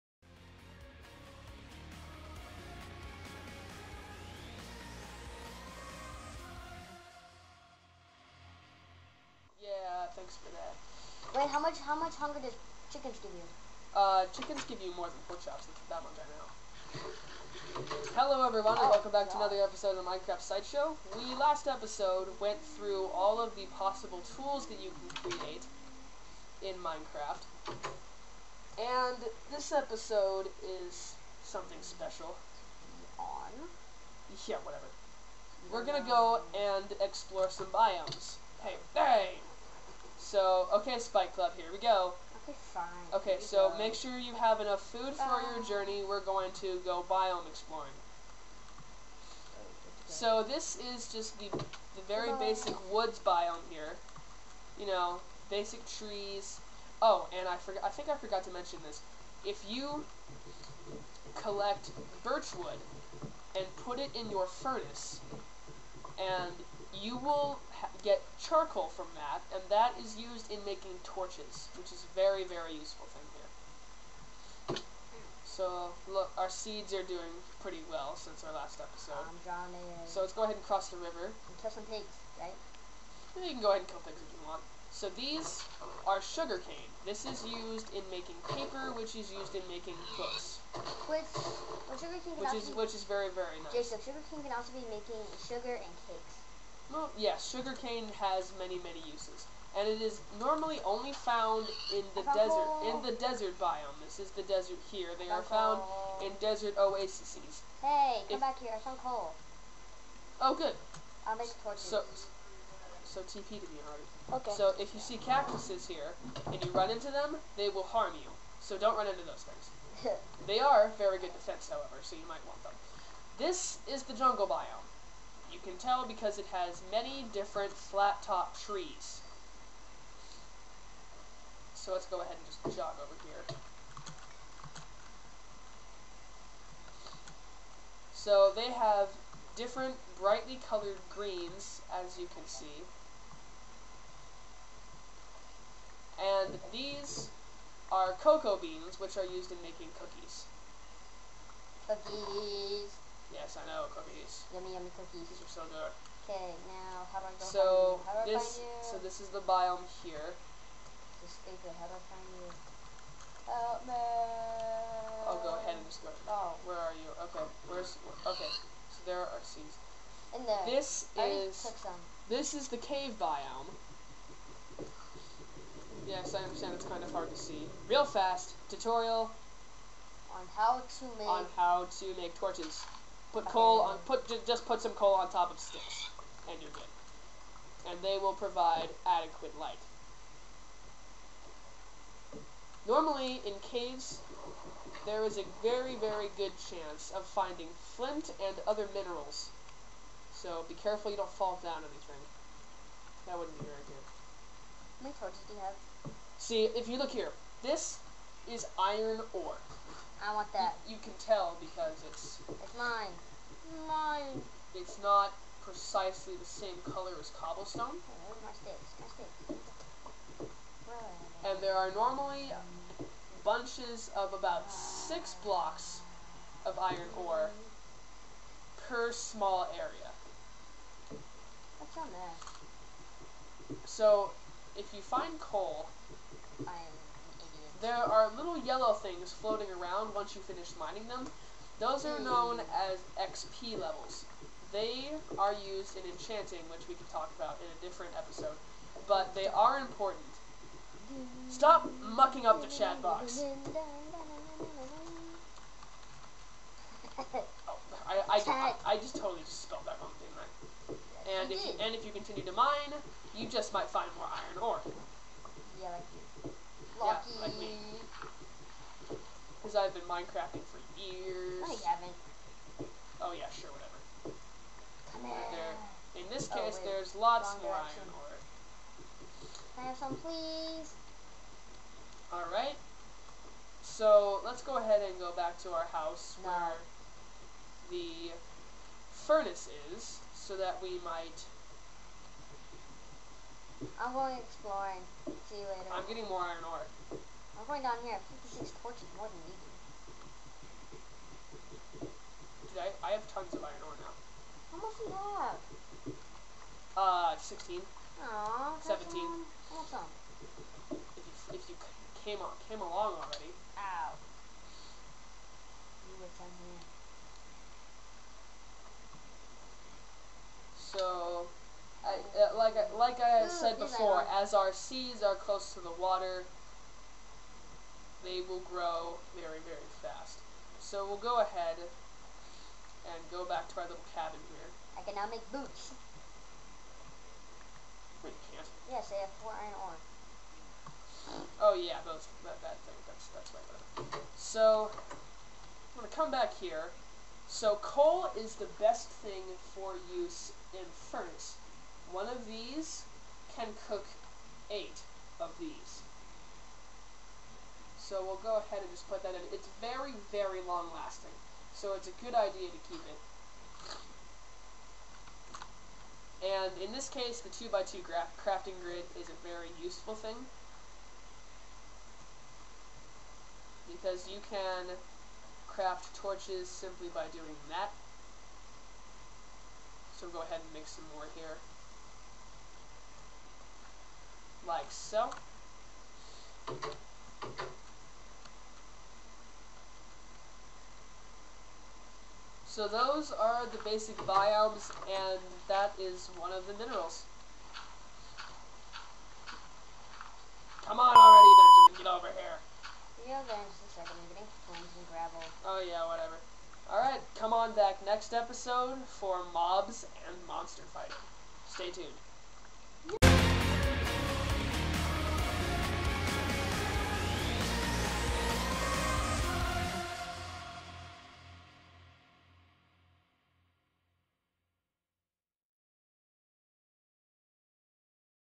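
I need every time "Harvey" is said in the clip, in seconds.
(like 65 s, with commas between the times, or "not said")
113 s.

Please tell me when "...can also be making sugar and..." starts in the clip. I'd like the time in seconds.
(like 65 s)
94 s.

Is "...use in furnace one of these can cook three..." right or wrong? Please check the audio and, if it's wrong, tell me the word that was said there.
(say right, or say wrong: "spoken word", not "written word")
wrong: "eight", not "three".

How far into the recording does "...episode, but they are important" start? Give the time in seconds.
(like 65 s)
248 s.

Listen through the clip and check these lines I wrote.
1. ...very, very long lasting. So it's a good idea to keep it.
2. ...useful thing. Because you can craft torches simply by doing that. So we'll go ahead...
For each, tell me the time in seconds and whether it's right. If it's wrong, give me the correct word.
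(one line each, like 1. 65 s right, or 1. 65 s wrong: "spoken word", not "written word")
1. 359 s right
2. 369 s right.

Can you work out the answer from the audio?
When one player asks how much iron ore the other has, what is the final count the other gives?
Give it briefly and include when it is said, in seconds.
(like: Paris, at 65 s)
17, at 308 s.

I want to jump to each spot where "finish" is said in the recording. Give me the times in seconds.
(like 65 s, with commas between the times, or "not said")
240 s.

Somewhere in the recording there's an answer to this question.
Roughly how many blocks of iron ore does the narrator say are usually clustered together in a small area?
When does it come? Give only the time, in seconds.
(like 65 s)
224 s.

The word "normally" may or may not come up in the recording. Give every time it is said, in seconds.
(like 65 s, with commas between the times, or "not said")
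100 s, 192 s, 221 s.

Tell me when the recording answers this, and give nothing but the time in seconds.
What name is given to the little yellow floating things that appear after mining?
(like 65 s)
243 s.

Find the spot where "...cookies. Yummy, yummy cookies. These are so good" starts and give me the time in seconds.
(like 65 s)
153 s.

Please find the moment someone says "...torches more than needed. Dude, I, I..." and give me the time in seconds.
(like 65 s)
298 s.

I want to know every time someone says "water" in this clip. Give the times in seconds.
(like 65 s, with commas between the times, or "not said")
325 s.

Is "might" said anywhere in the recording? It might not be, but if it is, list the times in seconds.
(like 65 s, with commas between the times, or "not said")
122 s, 263 s, 291 s.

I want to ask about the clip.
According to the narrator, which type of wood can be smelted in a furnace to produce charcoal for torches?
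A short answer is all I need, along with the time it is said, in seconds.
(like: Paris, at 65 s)
Birch wood, at 62 s.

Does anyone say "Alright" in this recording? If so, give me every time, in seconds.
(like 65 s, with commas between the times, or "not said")
282 s, 406 s.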